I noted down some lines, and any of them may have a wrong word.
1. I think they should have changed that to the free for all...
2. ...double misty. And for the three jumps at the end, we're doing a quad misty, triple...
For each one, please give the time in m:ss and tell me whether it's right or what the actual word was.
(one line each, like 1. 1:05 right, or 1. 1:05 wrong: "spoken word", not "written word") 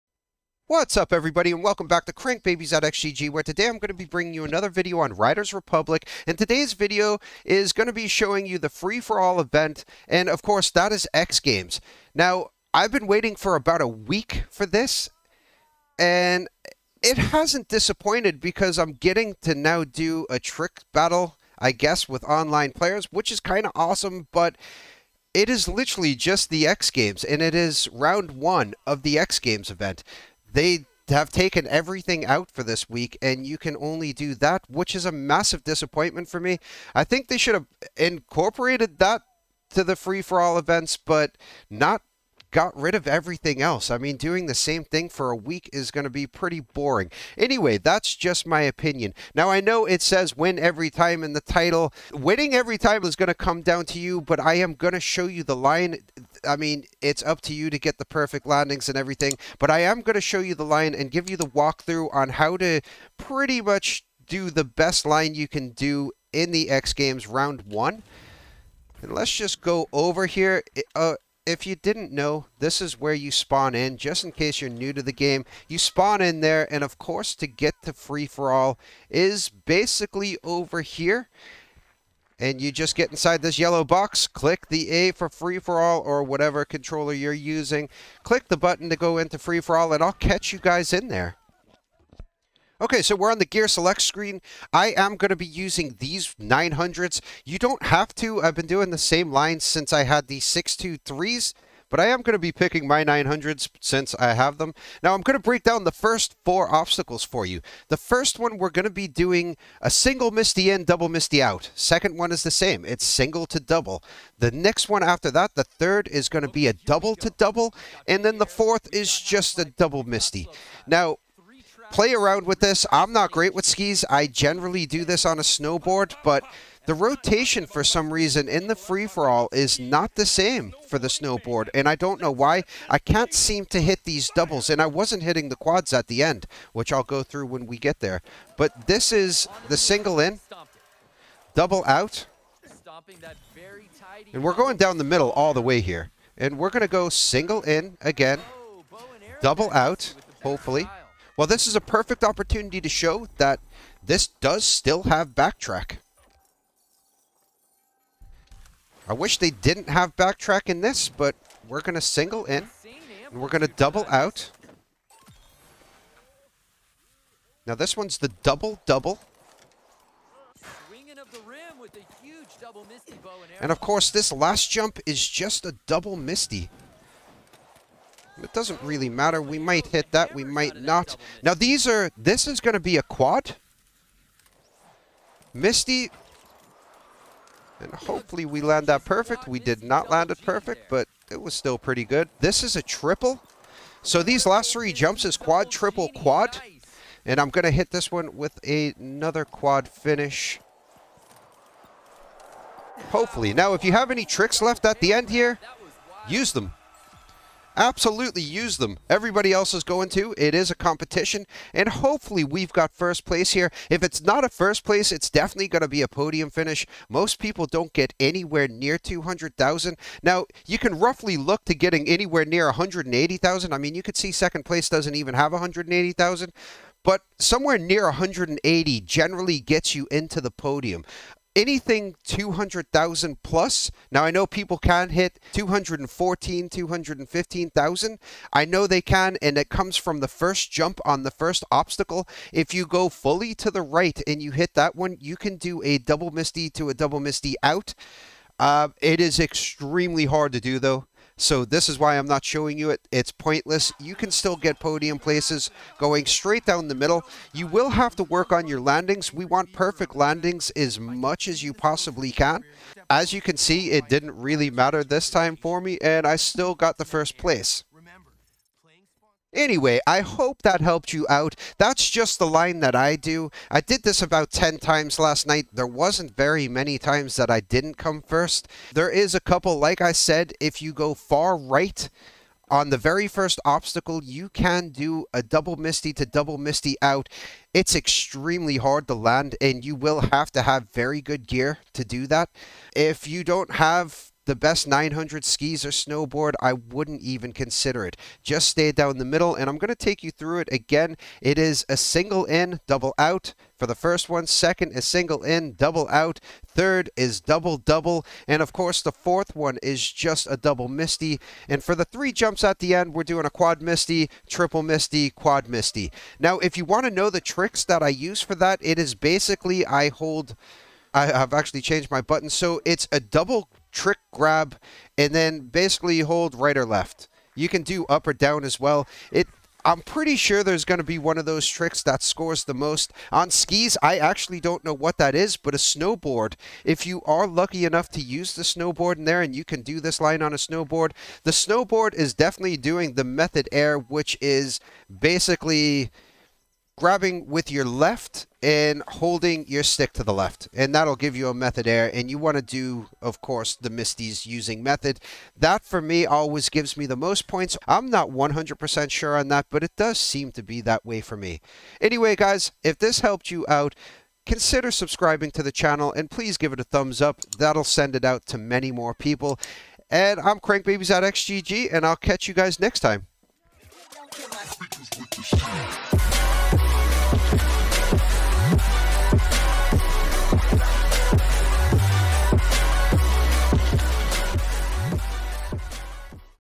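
1. 0:36 wrong: "incorporated", not "changed"
2. 5:10 right.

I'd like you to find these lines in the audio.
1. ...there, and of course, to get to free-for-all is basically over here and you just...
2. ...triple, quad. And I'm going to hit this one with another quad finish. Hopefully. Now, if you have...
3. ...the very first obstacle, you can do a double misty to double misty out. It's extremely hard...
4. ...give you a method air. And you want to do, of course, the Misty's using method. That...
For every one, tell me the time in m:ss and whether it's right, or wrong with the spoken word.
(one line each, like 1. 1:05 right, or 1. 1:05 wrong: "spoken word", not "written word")
1. 1:16 right
2. 3:15 right
3. 4:42 right
4. 5:51 right.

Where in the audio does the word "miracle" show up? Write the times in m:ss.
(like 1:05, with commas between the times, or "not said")
not said.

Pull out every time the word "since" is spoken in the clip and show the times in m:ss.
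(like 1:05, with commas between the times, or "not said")
1:39, 1:43.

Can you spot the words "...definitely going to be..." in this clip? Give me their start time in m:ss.
3:35.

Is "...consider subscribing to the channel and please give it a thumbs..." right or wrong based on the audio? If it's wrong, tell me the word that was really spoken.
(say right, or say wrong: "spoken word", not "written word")
right.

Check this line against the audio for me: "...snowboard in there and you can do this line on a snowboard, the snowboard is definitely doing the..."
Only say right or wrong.
right.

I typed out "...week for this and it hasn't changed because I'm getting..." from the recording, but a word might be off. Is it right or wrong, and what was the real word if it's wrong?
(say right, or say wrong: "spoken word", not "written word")
wrong: "disappointed", not "changed".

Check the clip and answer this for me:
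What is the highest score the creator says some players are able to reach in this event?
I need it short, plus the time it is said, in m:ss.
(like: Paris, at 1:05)
215,000, at 3:56.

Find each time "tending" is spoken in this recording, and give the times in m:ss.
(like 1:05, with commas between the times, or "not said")
not said.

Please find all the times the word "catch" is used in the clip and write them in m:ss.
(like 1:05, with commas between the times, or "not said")
1:30, 6:12.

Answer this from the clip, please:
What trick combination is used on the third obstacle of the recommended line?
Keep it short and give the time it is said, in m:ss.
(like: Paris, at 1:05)
double to double, at 1:56.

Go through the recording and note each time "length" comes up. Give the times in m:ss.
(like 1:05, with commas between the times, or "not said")
not said.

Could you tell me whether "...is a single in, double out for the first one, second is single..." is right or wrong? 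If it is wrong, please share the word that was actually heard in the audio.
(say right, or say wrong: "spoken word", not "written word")
right.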